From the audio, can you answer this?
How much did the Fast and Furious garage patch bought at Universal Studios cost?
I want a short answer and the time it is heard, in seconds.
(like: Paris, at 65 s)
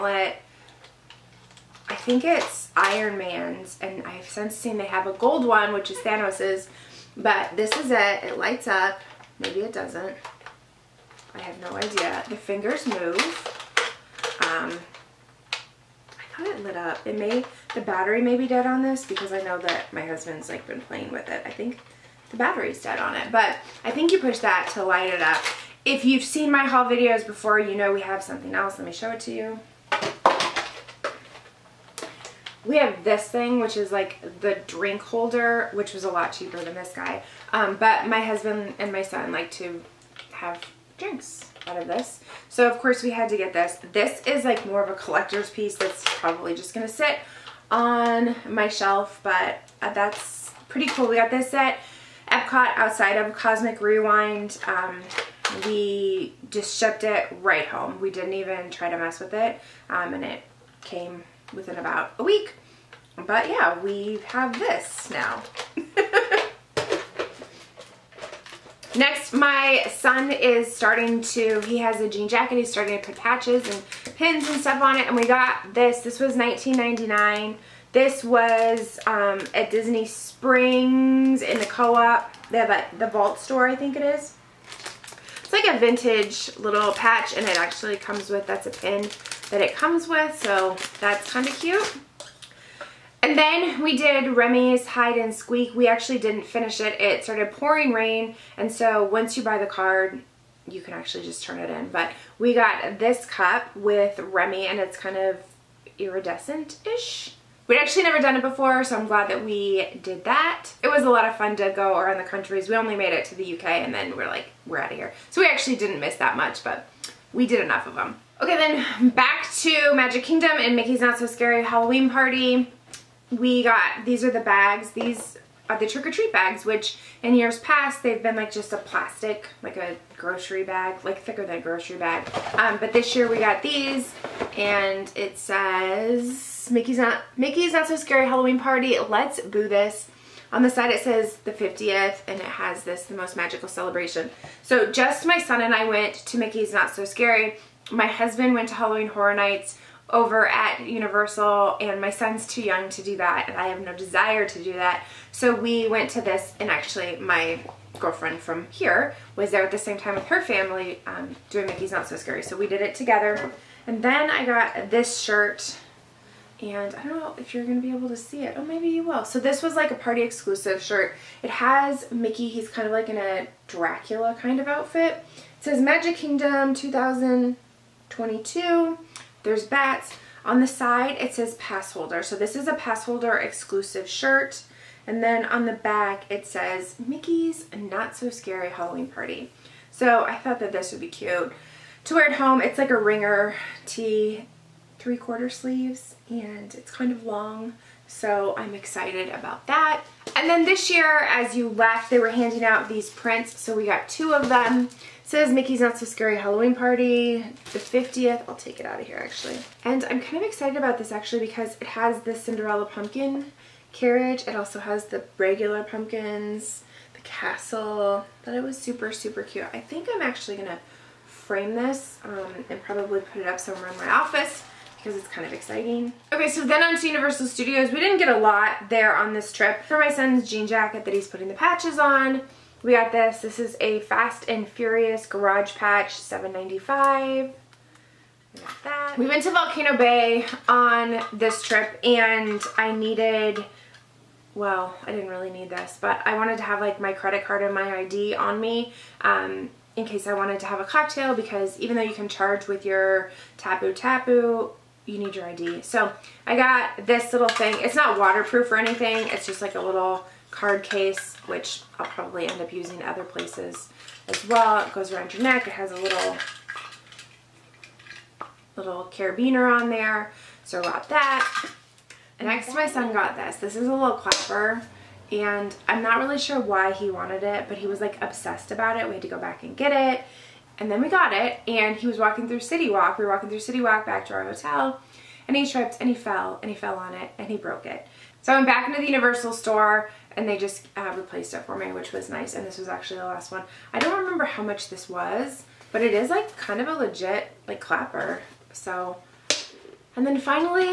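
$7.95, at 236 s.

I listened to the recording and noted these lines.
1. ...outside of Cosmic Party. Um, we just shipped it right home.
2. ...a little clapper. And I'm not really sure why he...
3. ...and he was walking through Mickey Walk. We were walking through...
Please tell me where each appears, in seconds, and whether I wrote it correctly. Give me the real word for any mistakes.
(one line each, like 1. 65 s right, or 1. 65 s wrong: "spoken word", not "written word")
1. 52 s wrong: "Rewind", not "Party"
2. 273 s right
3. 281 s wrong: "City", not "Mickey".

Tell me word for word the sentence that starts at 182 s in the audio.
So this is a pass holder exclusive shirt.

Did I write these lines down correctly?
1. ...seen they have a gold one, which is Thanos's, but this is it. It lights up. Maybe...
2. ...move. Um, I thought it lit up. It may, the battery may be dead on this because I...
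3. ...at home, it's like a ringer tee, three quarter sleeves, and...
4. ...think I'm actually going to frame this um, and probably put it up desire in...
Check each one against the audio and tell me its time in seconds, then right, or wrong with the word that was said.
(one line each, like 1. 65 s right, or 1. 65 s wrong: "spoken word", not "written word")
1. 4 s right
2. 12 s right
3. 192 s right
4. 219 s wrong: "somewhere", not "desire".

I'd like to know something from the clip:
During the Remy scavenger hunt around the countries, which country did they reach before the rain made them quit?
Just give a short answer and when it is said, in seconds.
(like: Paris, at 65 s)
UK, at 113 s.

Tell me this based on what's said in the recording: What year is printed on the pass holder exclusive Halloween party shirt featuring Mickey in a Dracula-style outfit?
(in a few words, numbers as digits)
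2022.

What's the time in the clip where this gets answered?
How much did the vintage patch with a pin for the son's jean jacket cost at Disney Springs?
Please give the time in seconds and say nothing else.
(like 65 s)
76 s.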